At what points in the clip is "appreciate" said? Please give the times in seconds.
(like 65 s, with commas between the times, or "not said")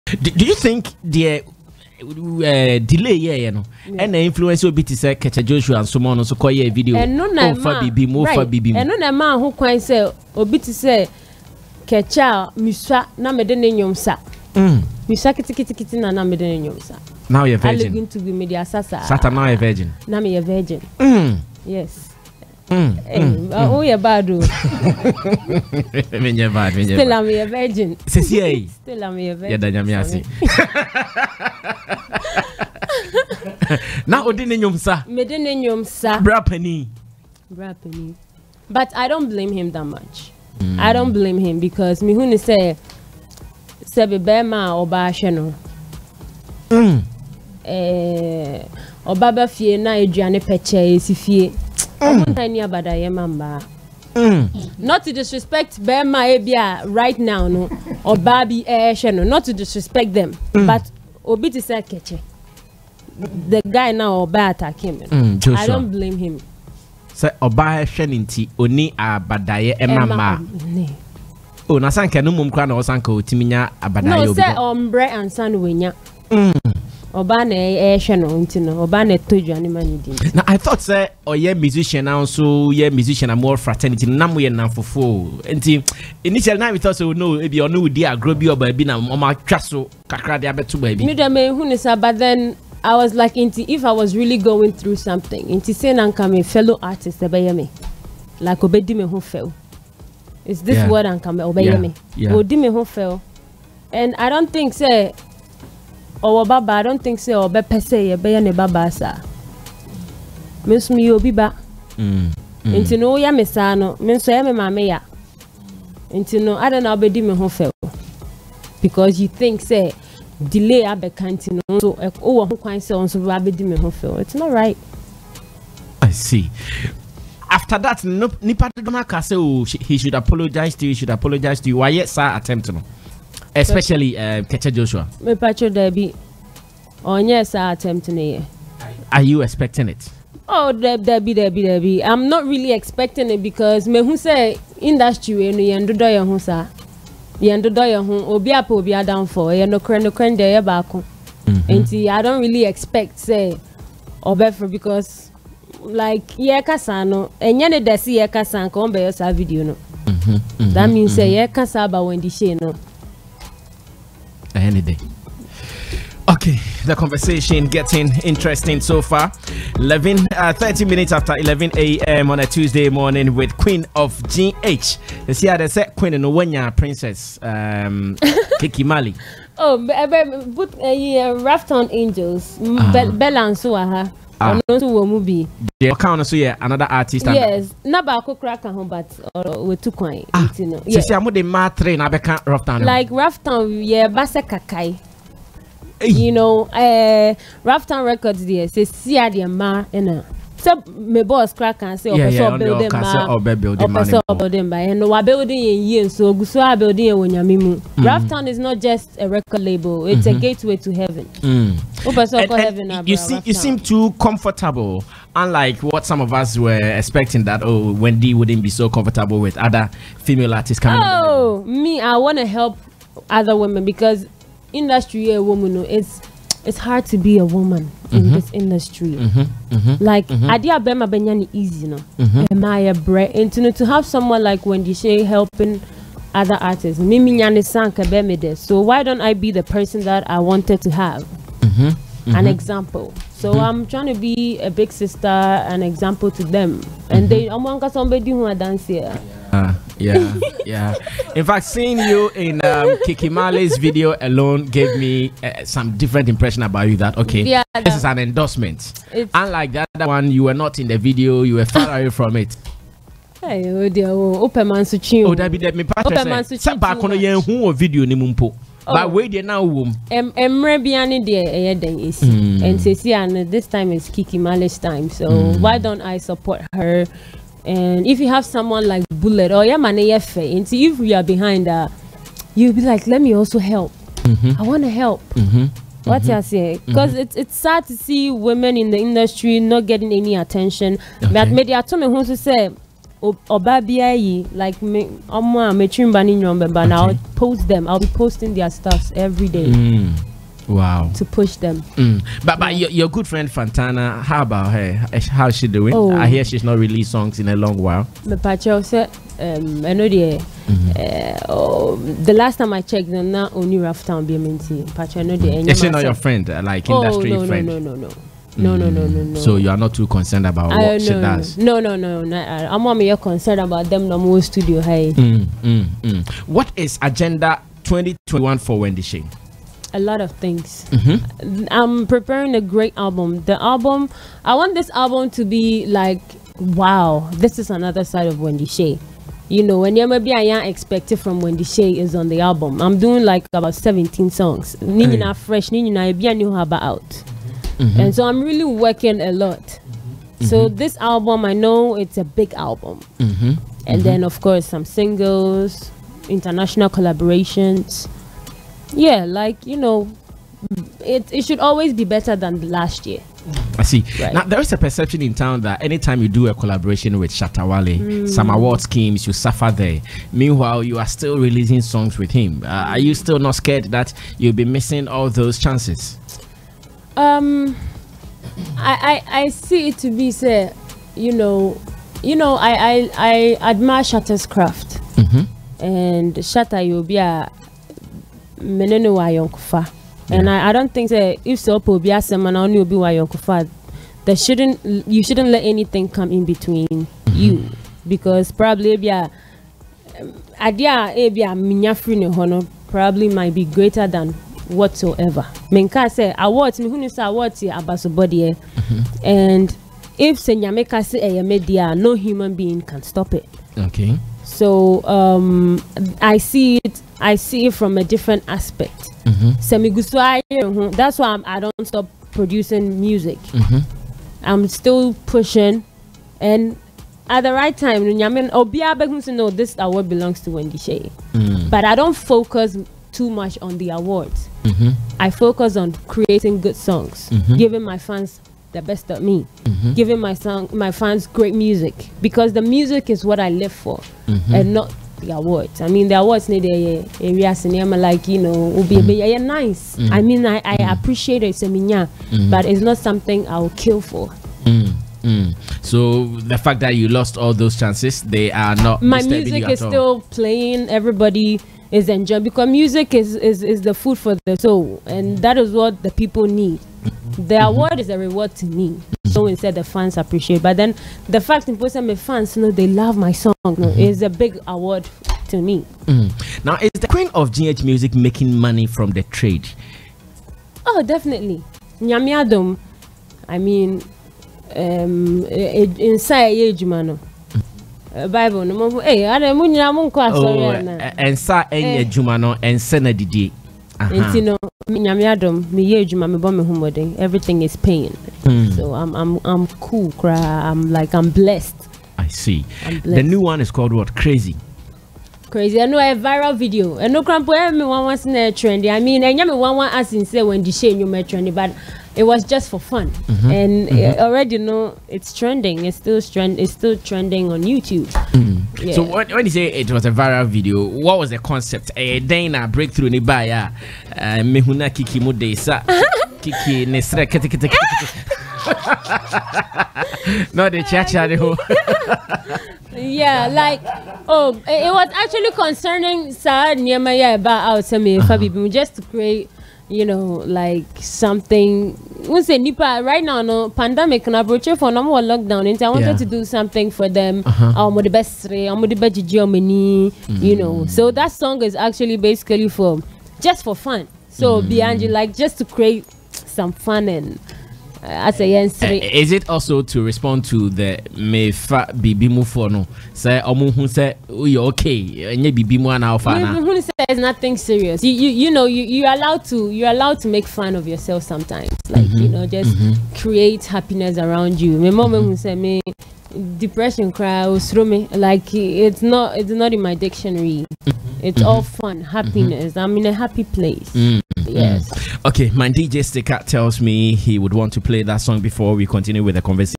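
450 s, 470 s.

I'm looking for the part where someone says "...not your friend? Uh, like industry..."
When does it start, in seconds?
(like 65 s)
315 s.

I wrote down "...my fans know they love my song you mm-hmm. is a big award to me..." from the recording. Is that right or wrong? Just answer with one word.
right.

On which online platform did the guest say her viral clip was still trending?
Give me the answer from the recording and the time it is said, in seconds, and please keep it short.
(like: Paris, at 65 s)
YouTube, at 517 s.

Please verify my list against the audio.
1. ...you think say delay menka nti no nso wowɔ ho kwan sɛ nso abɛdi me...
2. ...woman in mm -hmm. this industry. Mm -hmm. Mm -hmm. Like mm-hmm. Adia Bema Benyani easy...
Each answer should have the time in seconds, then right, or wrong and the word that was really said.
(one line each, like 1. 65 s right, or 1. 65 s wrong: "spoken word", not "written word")
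1. 119 s wrong: "abɛka", not "menka"
2. 227 s right.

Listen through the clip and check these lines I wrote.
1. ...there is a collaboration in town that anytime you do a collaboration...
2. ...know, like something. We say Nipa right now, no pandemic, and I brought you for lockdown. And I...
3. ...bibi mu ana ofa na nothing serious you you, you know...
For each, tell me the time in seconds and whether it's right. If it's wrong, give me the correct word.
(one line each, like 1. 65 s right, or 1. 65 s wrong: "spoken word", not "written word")
1. 364 s wrong: "perception", not "collaboration"
2. 540 s right
3. 565 s right.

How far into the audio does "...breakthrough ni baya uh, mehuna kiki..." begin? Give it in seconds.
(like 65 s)
522 s.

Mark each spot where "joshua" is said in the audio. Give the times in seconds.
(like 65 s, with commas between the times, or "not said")
5 s, 134 s.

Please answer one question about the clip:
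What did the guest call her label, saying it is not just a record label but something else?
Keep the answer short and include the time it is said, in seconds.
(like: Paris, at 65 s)
gateway to heaven, at 210 s.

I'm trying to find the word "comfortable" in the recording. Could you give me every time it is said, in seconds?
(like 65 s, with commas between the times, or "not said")
214 s, 218 s.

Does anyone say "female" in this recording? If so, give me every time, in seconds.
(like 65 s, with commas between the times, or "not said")
220 s.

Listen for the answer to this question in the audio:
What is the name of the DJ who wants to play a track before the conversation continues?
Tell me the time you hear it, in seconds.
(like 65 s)
585 s.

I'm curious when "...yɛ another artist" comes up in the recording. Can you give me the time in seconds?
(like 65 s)
186 s.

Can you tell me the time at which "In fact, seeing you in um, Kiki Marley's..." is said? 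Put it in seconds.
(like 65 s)
251 s.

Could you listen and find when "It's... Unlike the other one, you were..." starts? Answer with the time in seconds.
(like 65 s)
259 s.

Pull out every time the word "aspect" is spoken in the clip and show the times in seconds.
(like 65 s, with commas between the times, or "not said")
418 s.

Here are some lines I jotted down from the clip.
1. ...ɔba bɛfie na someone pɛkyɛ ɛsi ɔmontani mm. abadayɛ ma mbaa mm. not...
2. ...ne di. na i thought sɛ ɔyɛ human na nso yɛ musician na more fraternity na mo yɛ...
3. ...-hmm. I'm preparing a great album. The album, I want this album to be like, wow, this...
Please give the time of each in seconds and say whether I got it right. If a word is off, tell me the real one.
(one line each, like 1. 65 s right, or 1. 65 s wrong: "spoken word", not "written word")
1. 49 s wrong: "aduane", not "someone"
2. 79 s wrong: "musician", not "human"
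3. 330 s right.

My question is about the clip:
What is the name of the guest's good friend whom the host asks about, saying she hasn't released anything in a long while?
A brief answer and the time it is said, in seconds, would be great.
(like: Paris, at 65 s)
Fantana, at 303 s.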